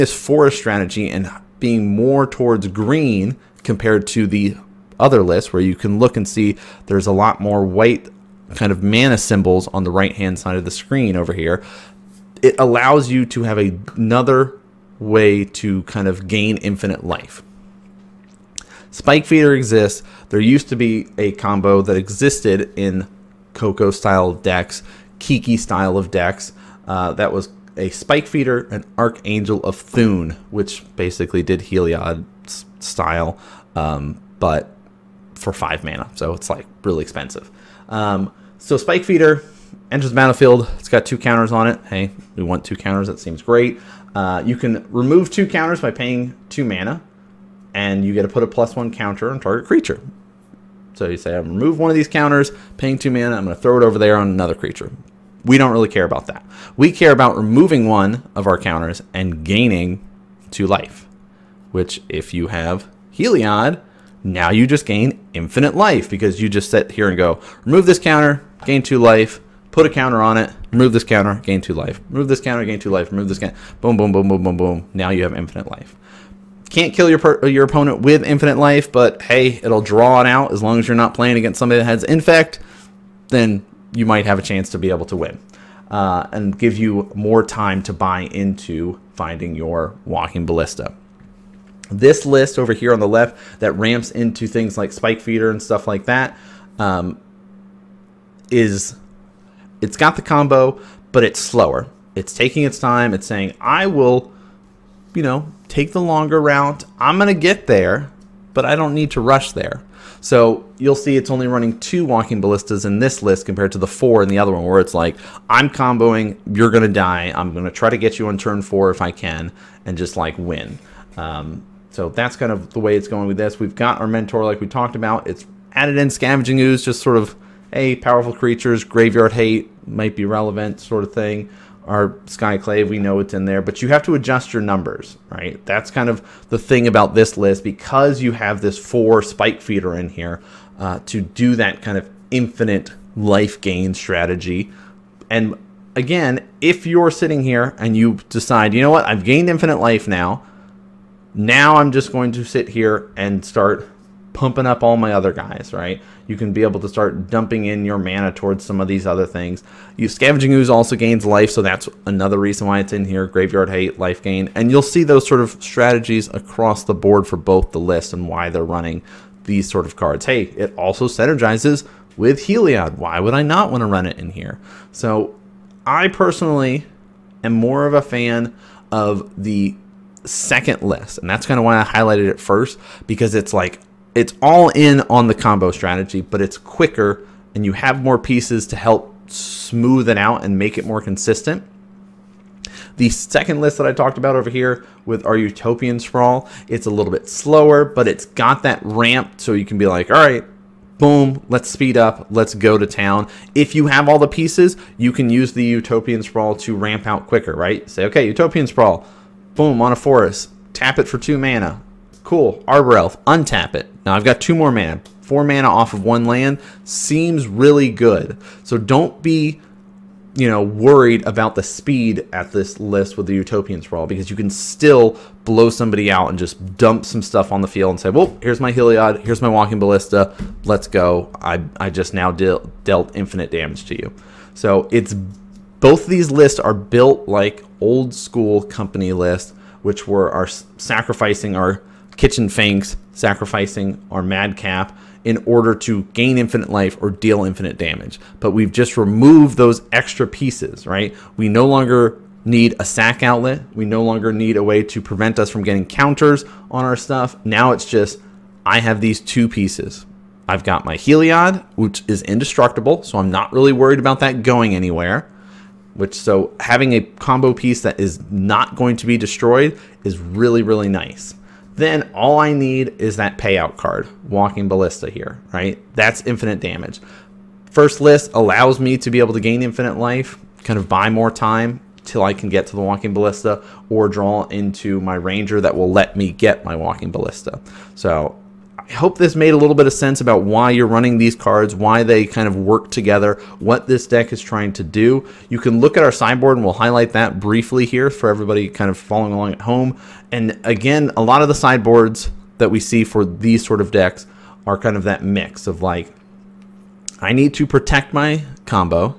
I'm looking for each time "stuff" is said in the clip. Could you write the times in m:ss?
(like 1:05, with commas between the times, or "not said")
1:35, 3:47, 4:16.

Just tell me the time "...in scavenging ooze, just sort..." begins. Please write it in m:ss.
2:05.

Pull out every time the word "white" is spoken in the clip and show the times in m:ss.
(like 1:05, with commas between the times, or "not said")
0:07.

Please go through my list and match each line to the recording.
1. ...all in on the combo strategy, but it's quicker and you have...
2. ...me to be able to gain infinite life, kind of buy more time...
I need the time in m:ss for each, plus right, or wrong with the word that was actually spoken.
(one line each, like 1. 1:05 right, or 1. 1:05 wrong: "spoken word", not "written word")
1. 3:04 right
2. 4:38 right.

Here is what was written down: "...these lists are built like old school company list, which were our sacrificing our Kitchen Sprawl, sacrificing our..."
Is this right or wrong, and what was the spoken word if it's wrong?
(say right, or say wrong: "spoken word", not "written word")
wrong: "Finks", not "Sprawl".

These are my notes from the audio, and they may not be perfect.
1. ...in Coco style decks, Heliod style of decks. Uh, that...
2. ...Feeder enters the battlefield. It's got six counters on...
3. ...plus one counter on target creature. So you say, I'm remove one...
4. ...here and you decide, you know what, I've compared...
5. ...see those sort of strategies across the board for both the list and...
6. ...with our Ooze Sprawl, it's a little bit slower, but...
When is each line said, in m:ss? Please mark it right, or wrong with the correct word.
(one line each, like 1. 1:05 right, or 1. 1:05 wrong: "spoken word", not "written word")
1. 0:22 wrong: "Kiki", not "Heliod"
2. 0:39 wrong: "two", not "six"
3. 0:48 right
4. 2:27 wrong: "gained", not "compared"
5. 2:44 right
6. 3:15 wrong: "Utopian", not "Ooze".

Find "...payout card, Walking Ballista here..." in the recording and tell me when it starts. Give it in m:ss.
4:33.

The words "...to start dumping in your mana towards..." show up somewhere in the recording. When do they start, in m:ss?
2:36.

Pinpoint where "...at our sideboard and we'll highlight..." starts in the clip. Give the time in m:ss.
4:55.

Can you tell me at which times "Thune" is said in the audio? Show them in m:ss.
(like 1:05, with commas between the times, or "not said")
0:29.